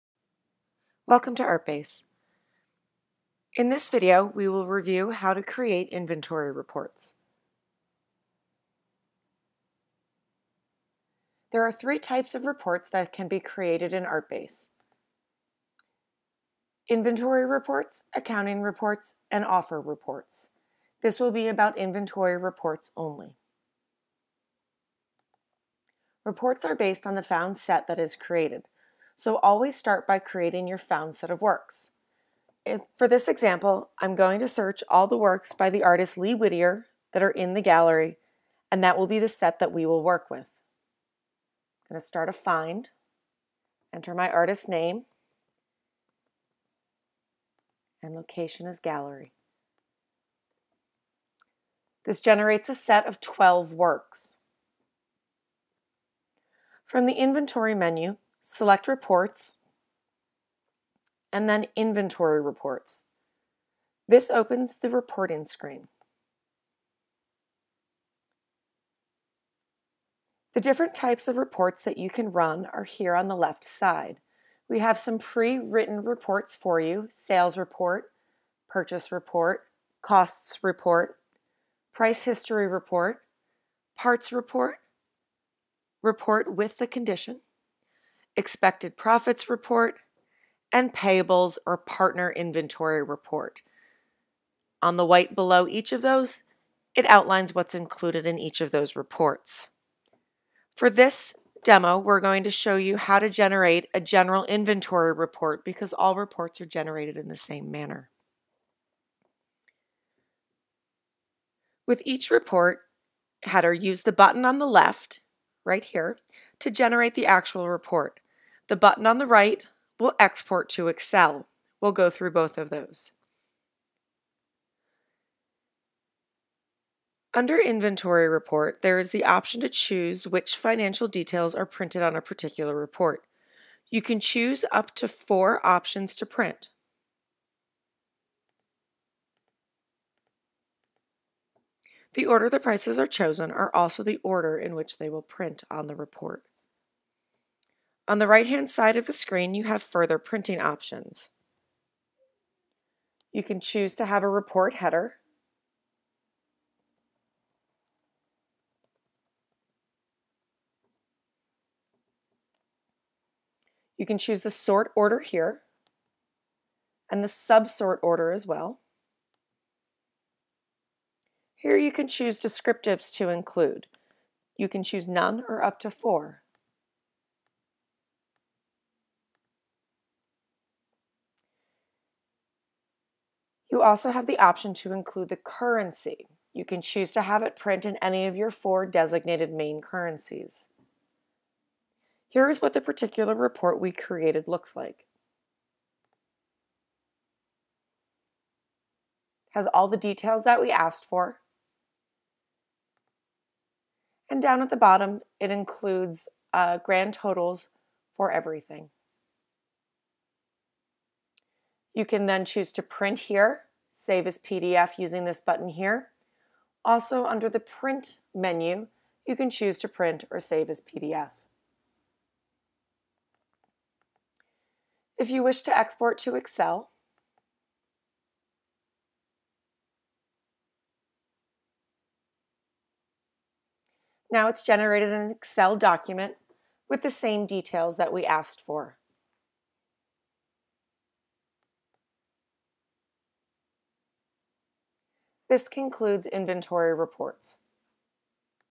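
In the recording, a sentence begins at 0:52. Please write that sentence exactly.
This generates a set of 12 works.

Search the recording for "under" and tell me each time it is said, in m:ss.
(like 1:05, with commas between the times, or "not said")
2:07, 3:37.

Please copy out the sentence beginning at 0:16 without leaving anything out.
Inventory reports, accounting reports, and offer reports.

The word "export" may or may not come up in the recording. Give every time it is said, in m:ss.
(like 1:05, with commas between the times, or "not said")
2:00, 3:45.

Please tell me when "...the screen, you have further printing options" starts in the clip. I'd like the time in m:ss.
2:29.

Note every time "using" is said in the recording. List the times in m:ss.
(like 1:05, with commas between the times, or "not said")
3:34.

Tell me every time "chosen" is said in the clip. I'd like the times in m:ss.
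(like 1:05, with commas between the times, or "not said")
2:23.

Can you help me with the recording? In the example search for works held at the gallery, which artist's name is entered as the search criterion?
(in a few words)
Lee Whittier.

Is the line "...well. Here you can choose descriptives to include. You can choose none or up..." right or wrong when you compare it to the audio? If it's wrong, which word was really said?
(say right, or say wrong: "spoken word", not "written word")
right.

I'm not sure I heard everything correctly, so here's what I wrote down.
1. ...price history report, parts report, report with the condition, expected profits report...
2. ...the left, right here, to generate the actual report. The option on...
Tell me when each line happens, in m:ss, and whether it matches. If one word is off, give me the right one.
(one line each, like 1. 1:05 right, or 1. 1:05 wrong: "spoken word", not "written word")
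1. 1:21 right
2. 1:54 wrong: "button", not "option".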